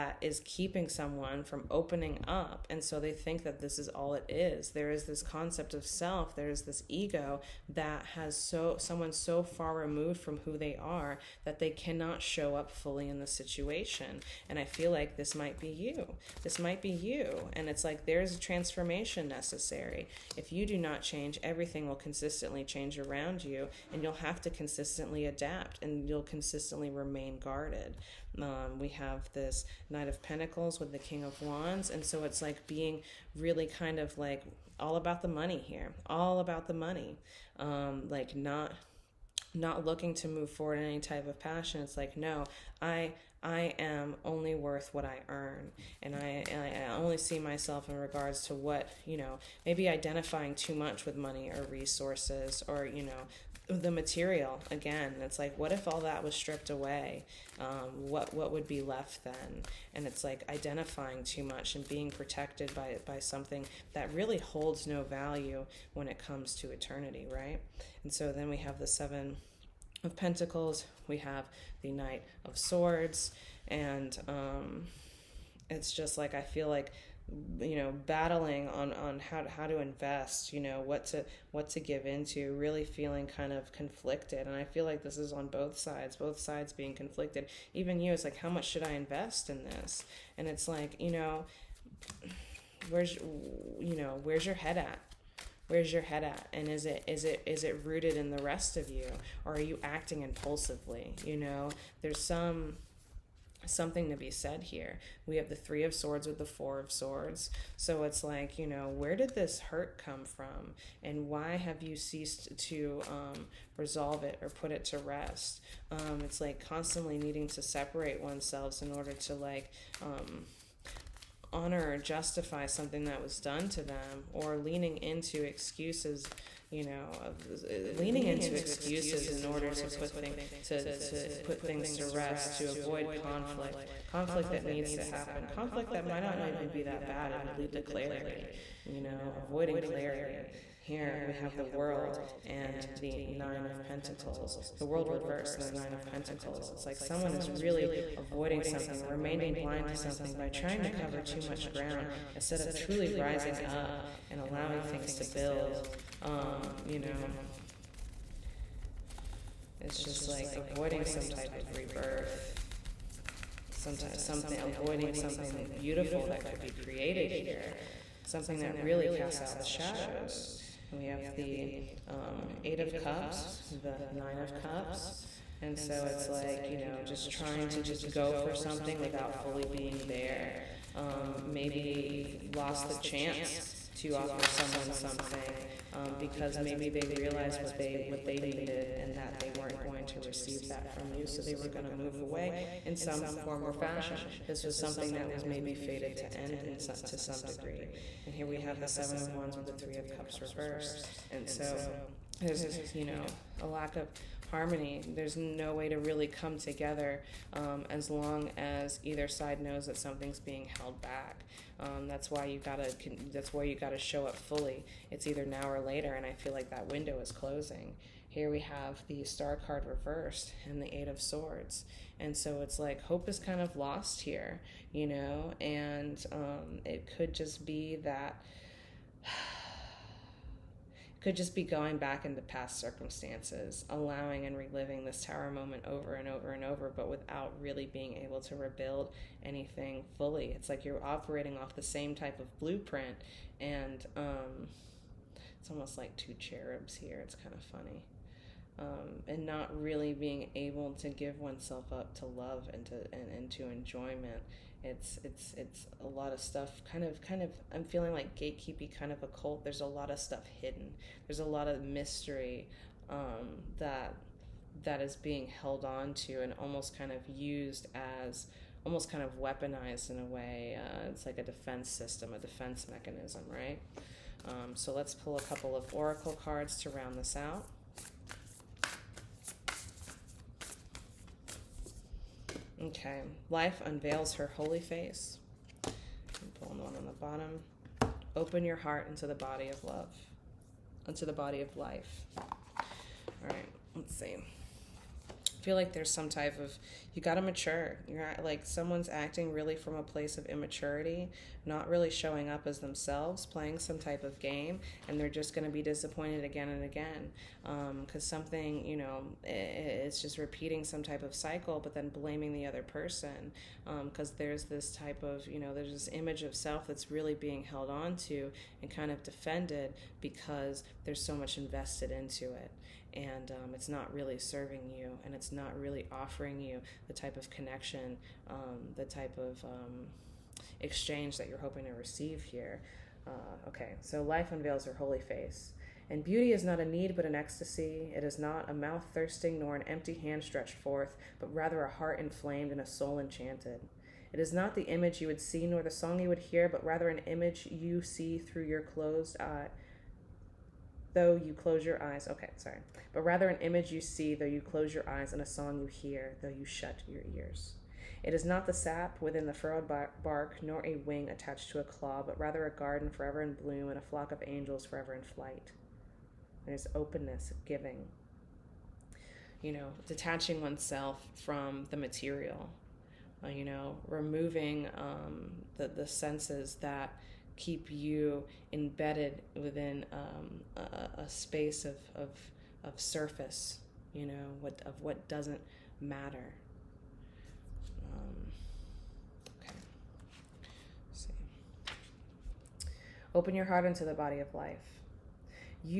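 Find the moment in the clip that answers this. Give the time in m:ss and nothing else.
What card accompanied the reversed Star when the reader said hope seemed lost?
3:40.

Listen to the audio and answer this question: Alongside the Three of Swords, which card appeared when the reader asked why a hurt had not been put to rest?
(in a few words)
Four of Swords.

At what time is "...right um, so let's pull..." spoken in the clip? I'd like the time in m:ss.
4:33.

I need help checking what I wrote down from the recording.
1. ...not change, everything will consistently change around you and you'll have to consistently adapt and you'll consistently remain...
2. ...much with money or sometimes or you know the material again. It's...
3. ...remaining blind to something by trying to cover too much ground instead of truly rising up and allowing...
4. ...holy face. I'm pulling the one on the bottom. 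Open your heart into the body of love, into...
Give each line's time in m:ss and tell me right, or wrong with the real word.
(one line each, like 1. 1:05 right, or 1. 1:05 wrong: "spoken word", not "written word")
1. 0:20 right
2. 0:50 wrong: "resources", not "sometimes"
3. 2:29 right
4. 4:44 right.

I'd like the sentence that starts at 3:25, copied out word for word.
There's no way to really come together um, as long as either side knows that something's being held back.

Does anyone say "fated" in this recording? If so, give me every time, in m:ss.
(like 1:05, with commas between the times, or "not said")
3:15.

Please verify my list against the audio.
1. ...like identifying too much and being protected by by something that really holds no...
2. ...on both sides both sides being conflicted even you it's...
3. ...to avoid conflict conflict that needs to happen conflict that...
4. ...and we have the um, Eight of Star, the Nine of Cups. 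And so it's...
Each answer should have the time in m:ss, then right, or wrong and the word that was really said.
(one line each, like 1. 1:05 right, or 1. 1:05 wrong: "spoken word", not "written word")
1. 1:00 right
2. 1:25 right
3. 2:12 right
4. 2:50 wrong: "Cups", not "Star".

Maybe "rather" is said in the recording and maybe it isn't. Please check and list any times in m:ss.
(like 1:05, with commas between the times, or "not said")
5:41, 5:46, 5:53, 6:02.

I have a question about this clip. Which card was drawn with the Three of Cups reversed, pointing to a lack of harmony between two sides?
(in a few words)
Seven of Wands.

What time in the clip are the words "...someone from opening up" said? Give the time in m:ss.
0:00.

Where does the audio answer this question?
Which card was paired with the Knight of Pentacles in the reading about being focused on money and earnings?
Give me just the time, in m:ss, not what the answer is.
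0:30.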